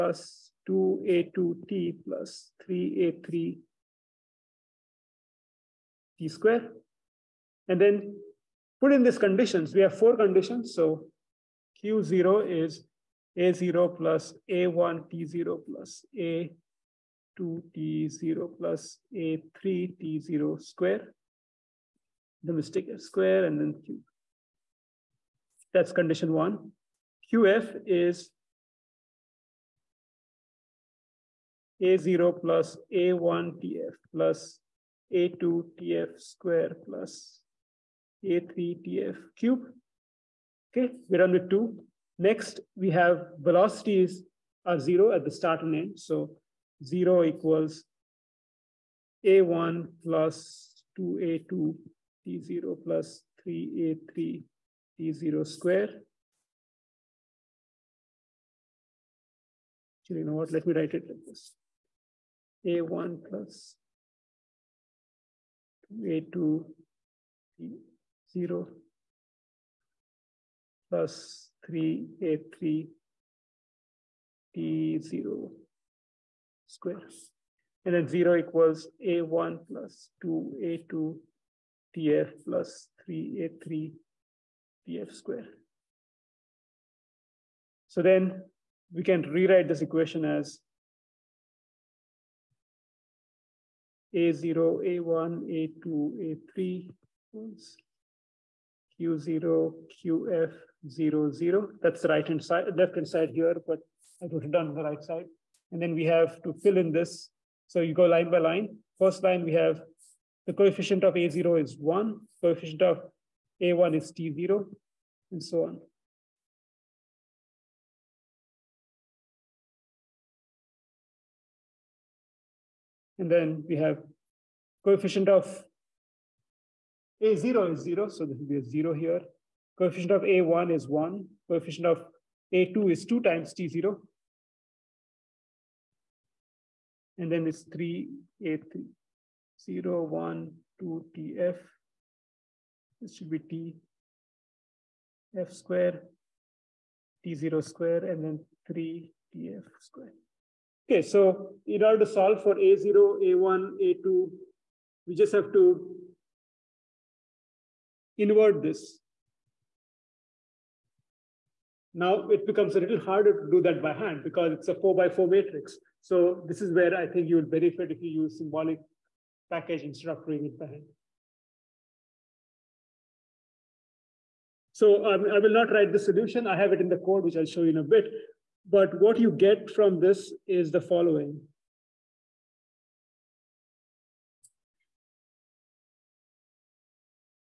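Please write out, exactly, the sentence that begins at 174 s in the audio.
So um, I will not write the solution.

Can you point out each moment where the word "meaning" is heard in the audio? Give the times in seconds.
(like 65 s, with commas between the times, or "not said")
not said.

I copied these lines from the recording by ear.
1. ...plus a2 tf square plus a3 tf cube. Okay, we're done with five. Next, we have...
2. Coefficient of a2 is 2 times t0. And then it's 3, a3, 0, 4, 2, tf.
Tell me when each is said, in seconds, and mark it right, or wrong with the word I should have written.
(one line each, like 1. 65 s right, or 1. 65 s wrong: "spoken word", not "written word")
1. 34 s wrong: "two", not "five"
2. 131 s wrong: "1", not "4".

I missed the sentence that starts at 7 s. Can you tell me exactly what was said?
And then put in these conditions.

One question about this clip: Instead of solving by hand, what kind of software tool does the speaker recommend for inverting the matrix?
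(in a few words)
symbolic package.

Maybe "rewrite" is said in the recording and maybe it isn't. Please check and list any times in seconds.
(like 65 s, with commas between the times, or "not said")
89 s.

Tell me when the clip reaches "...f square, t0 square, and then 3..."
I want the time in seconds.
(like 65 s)
145 s.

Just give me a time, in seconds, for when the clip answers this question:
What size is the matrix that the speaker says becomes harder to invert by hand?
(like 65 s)
164 s.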